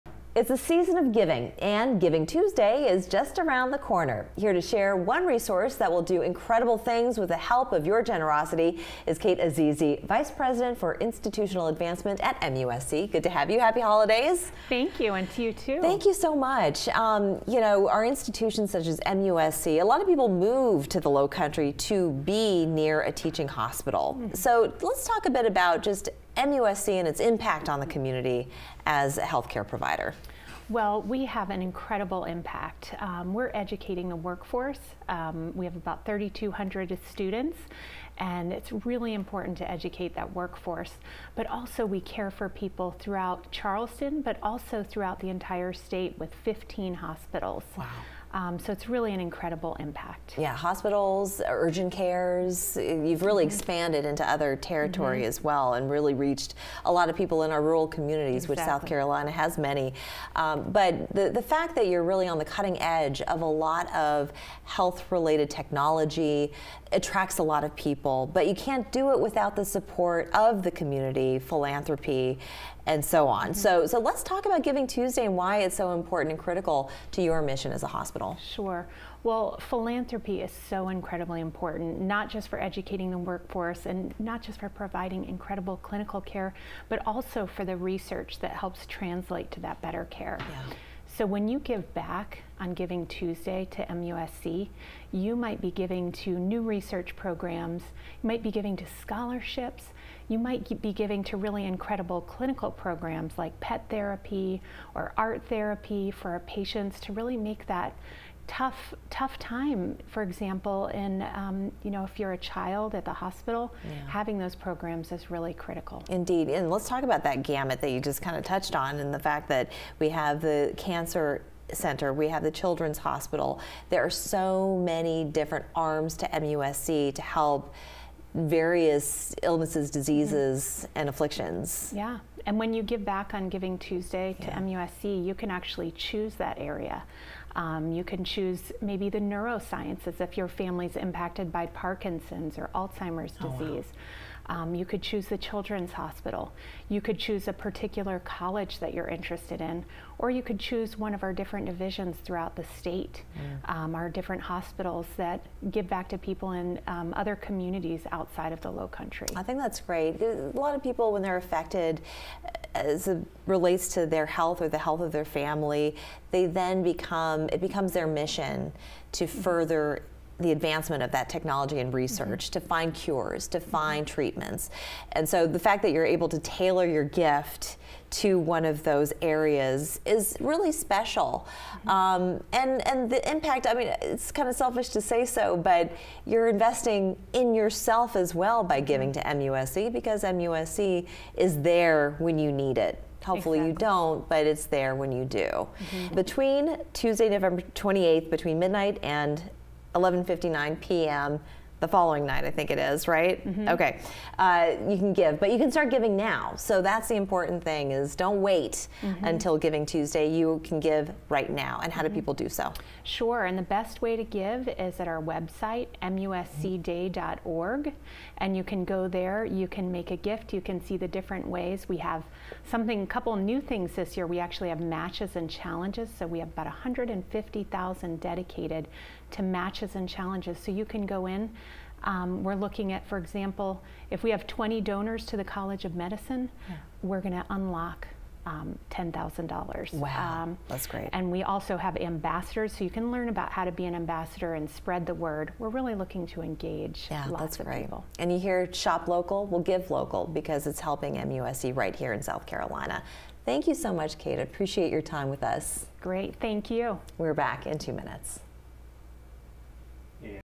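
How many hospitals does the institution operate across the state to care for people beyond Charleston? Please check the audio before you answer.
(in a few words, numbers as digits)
15.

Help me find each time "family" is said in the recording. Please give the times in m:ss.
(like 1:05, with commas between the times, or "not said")
2:20, 2:45.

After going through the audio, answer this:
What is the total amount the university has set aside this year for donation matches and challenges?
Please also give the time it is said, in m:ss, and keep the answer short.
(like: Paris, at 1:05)
150,000, at 3:46.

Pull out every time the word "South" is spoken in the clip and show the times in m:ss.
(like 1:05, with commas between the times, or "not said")
0:58, 4:12.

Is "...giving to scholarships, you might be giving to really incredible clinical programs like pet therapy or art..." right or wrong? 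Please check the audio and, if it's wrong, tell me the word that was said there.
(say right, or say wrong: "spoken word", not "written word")
right.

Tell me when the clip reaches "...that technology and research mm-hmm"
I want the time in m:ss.
2:51.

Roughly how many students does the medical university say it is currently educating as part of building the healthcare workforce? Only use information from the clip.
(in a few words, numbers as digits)
3,200.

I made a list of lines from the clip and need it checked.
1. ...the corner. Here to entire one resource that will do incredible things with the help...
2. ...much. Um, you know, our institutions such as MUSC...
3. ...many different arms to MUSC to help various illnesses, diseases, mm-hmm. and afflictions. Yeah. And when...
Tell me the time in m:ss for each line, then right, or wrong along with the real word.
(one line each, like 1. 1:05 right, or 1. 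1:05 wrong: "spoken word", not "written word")
1. 0:03 wrong: "share", not "entire"
2. 0:16 right
3. 2:04 right.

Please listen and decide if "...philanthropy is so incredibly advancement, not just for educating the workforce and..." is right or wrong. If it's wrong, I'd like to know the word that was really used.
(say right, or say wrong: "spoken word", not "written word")
wrong: "important", not "advancement".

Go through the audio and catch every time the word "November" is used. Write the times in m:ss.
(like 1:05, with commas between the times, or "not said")
3:17.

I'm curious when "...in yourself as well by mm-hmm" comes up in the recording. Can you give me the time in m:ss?
3:07.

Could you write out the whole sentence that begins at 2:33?
um, our different hospitals that give back to people in um, other communities outside of the low country.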